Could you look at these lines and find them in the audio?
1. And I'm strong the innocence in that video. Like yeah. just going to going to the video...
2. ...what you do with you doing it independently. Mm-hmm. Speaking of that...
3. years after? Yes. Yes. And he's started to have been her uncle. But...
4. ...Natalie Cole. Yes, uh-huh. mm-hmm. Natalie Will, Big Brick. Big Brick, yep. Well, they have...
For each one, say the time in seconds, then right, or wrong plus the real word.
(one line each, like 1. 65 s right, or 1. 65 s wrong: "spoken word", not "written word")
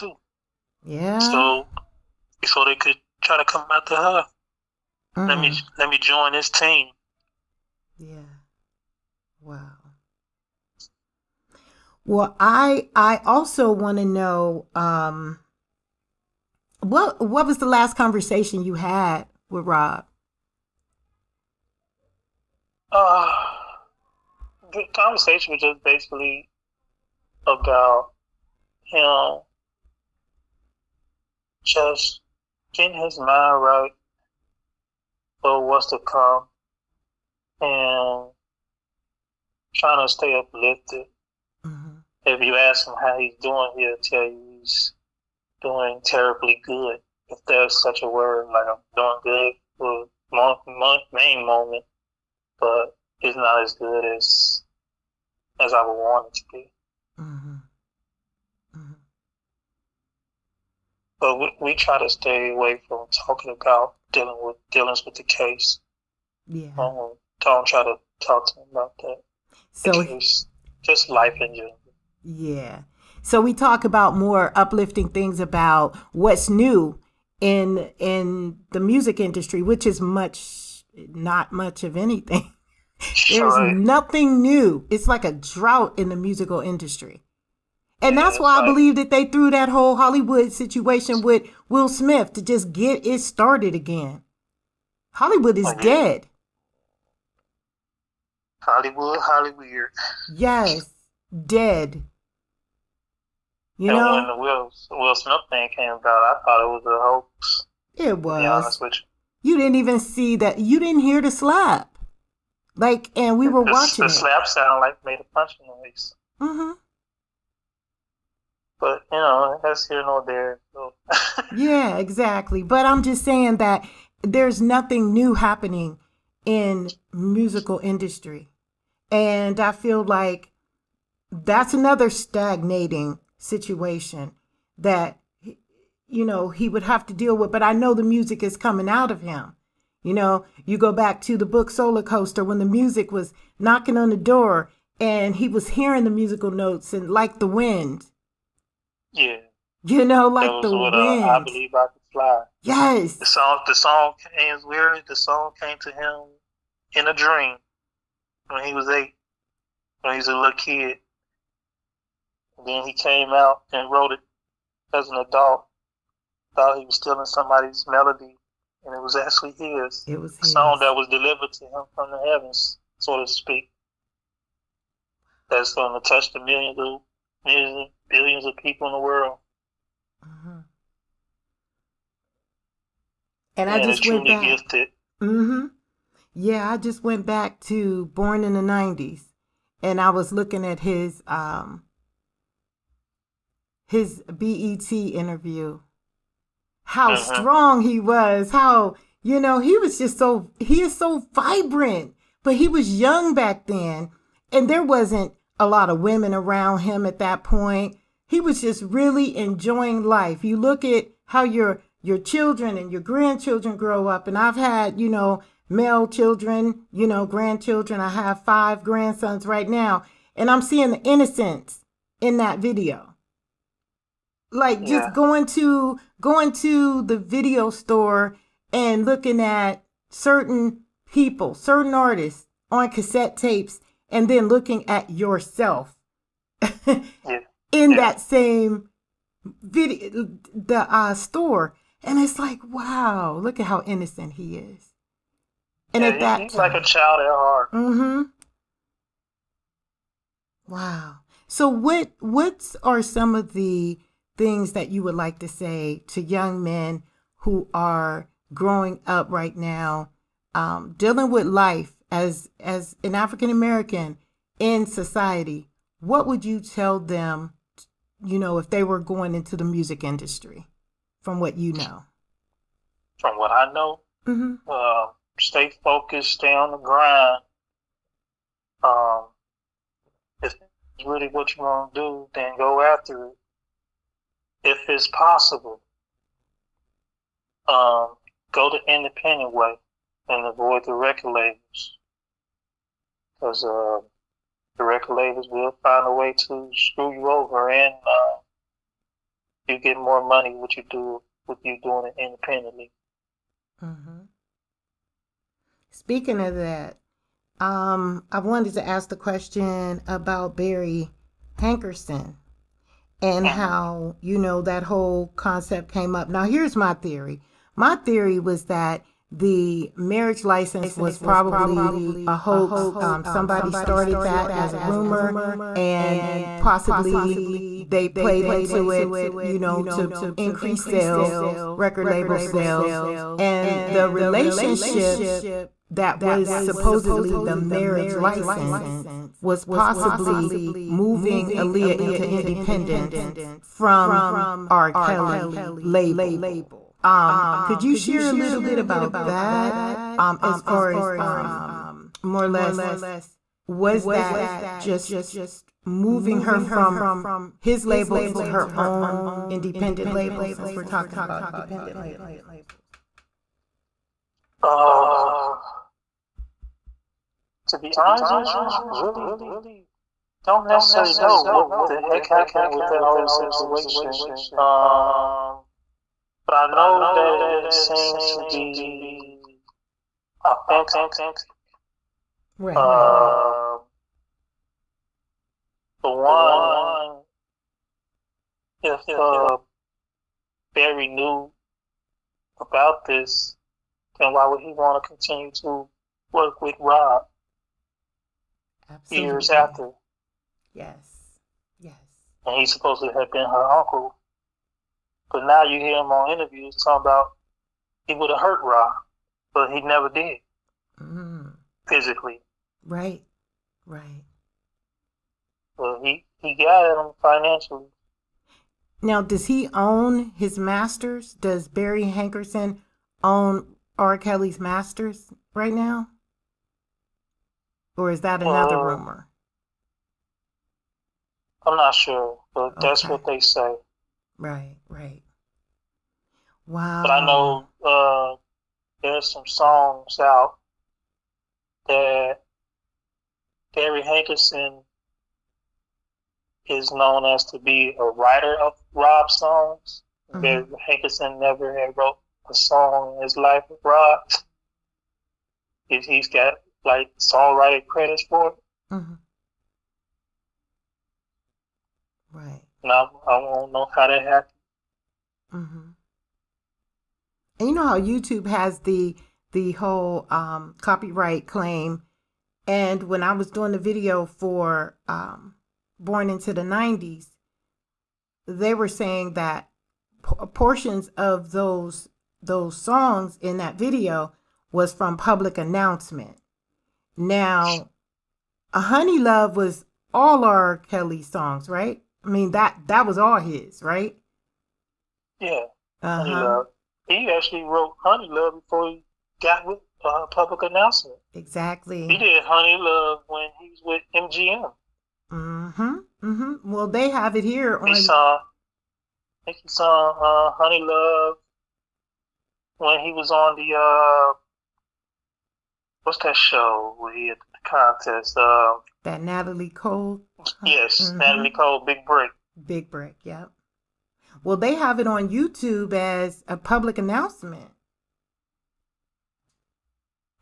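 1. 220 s wrong: "seeing", not "strong"
2. 300 s right
3. 399 s wrong: "supposed", not "started"
4. 519 s wrong: "Cole", not "Will".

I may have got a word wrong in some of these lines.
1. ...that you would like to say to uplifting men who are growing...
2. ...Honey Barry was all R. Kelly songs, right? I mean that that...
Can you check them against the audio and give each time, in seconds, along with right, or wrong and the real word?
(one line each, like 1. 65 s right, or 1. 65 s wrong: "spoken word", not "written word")
1. 254 s wrong: "young", not "uplifting"
2. 488 s wrong: "Love", not "Barry".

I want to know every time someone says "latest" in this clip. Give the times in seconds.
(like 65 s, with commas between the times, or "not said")
not said.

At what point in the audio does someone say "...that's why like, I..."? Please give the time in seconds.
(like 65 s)
88 s.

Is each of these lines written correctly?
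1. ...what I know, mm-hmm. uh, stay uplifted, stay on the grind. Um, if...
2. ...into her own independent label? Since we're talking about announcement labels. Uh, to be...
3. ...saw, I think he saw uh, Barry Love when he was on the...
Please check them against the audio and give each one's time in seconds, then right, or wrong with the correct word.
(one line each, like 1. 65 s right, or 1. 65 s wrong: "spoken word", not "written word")
1. 273 s wrong: "focused", not "uplifted"
2. 358 s wrong: "independent", not "announcement"
3. 508 s wrong: "Honey", not "Barry".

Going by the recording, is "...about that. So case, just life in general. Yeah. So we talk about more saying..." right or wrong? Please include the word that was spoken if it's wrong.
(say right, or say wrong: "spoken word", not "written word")
wrong: "uplifting", not "saying".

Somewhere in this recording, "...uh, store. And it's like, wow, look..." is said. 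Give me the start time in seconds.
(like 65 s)
240 s.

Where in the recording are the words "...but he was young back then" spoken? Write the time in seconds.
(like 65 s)
202 s.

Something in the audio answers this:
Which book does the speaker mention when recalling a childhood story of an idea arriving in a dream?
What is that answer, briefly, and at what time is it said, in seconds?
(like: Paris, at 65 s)
Soulacoaster, at 141 s.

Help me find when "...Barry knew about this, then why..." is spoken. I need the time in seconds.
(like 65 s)
390 s.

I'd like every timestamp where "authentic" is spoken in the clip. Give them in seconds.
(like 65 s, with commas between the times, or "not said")
380 s.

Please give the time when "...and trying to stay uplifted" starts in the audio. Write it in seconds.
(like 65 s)
37 s.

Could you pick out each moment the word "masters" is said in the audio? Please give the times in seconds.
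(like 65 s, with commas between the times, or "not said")
420 s, 424 s.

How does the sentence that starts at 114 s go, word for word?
sound like made a punching noise.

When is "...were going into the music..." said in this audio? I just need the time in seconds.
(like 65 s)
268 s.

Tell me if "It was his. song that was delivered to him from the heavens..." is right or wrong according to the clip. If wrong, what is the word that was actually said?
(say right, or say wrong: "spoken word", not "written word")
right.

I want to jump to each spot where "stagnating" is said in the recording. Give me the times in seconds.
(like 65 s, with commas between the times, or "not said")
132 s.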